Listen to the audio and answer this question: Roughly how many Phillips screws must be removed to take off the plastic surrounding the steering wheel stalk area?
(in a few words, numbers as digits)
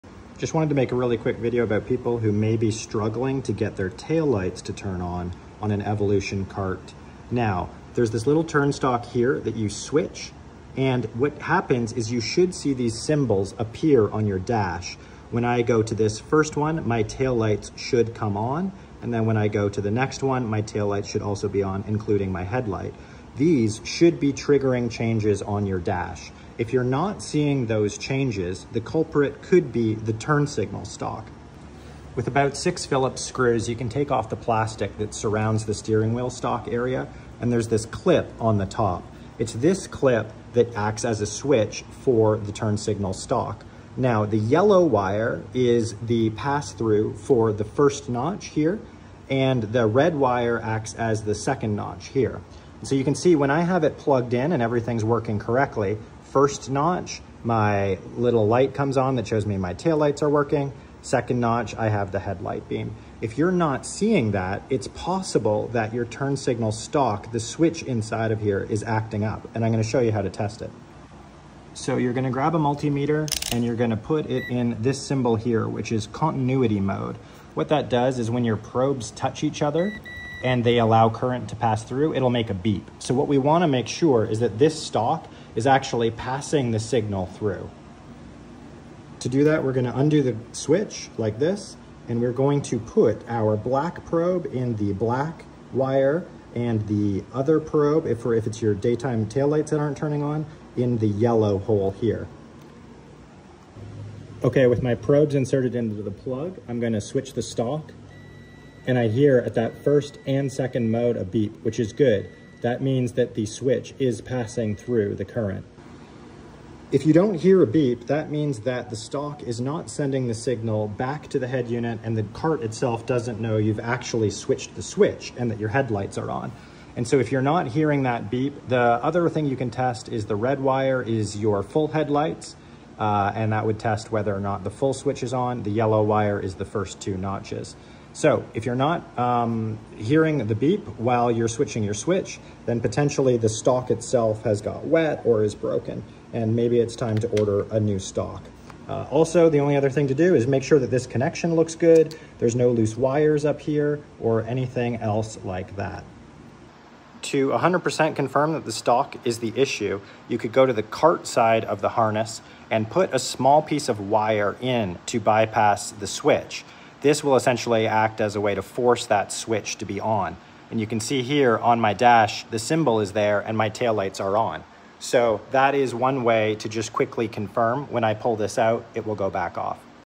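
6.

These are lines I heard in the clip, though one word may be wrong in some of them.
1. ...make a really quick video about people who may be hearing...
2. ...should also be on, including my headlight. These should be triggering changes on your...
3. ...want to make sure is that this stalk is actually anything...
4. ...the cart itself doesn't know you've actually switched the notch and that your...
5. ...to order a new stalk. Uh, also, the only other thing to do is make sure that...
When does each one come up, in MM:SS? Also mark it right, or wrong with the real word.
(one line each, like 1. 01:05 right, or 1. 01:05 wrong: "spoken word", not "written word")
1. 00:00 wrong: "struggling", not "hearing"
2. 00:21 right
3. 01:23 wrong: "passing", not "anything"
4. 02:02 wrong: "switch", not "notch"
5. 02:27 right.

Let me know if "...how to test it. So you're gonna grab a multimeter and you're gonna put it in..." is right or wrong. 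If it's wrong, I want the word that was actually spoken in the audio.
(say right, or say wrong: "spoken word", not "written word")
right.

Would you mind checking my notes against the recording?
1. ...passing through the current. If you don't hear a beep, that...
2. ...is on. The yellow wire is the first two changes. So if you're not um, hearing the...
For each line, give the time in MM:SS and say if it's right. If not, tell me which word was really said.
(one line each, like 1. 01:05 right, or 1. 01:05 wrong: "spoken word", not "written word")
1. 01:54 right
2. 02:15 wrong: "notches", not "changes".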